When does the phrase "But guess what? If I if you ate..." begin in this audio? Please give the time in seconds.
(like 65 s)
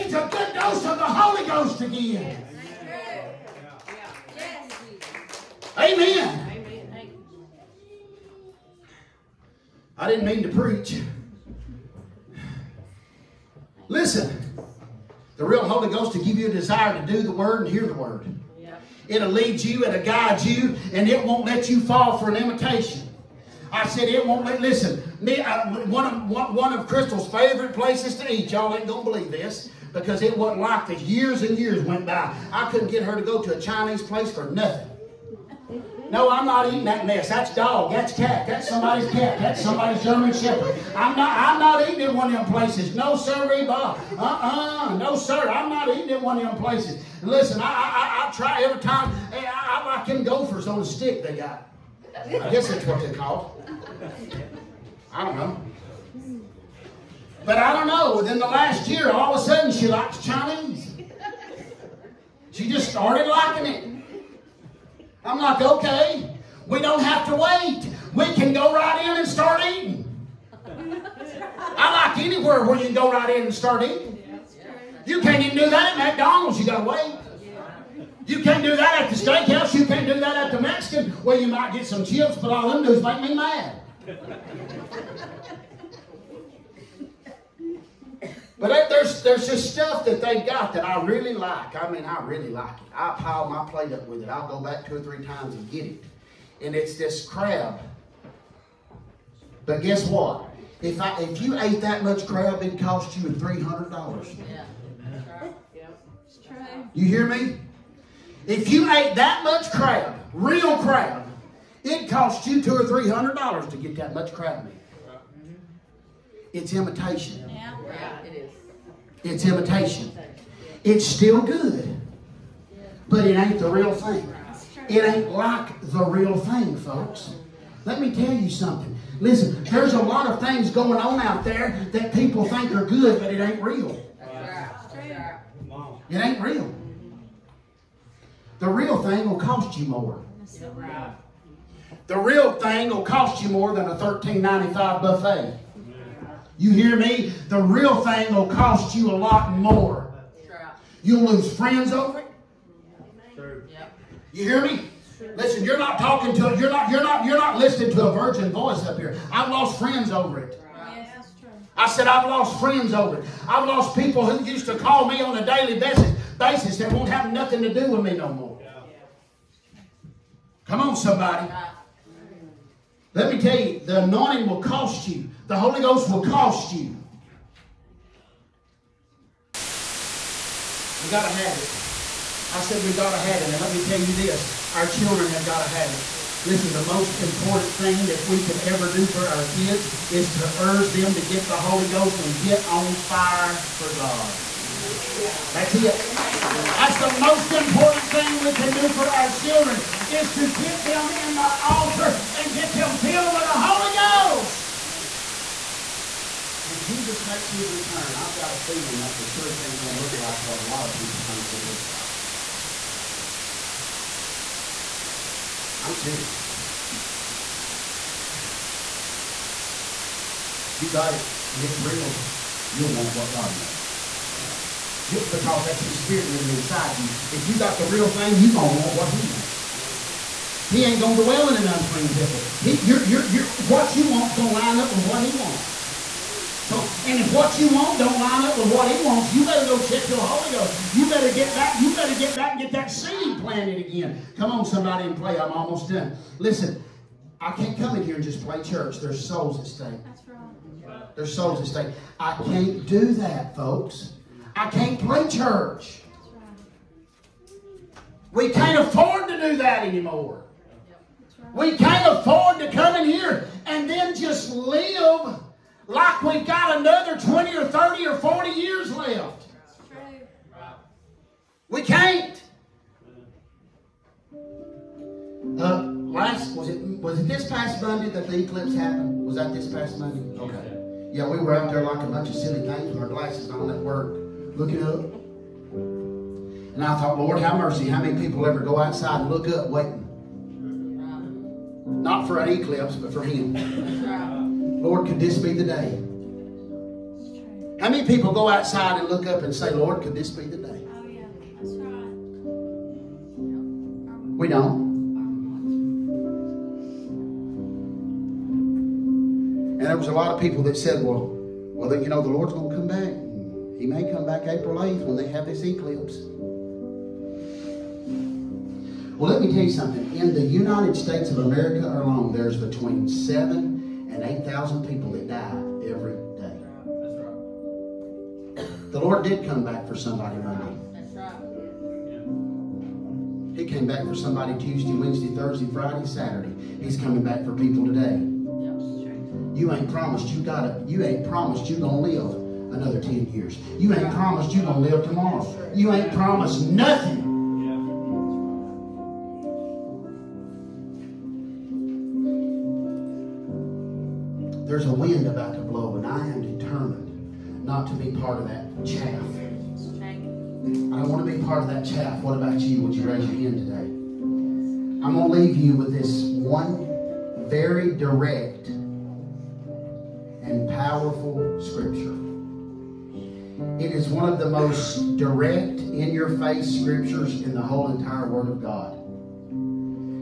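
99 s.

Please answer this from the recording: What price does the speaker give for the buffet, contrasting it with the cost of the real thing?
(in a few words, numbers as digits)
$13.95.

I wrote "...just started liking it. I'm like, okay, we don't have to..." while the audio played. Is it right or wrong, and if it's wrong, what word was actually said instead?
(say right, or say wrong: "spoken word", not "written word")
right.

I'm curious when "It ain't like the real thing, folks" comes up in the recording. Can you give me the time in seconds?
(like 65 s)
124 s.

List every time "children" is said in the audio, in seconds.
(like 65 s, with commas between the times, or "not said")
184 s, 199 s.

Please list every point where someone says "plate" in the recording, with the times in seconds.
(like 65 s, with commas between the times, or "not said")
93 s.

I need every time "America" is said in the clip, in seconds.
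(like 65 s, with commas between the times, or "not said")
321 s.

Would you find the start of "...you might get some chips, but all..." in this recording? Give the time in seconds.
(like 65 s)
81 s.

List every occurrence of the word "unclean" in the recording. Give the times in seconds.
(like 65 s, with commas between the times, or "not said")
231 s.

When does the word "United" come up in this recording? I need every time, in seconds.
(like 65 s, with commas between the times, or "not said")
320 s.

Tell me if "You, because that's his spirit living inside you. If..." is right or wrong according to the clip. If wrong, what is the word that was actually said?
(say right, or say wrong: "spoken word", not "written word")
right.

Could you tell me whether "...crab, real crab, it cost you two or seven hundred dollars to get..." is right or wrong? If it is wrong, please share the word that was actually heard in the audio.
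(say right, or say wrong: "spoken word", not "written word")
wrong: "three", not "seven".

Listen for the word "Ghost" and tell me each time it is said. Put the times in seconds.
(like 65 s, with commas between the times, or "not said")
1 s, 15 s, 175 s, 191 s, 204 s, 240 s.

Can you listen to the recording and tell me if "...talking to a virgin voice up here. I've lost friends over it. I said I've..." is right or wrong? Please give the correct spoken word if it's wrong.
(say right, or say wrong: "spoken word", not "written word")
wrong: "listening", not "talking".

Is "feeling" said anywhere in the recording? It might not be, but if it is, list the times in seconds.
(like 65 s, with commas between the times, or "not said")
208 s.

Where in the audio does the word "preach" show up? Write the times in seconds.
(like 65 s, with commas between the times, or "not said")
10 s.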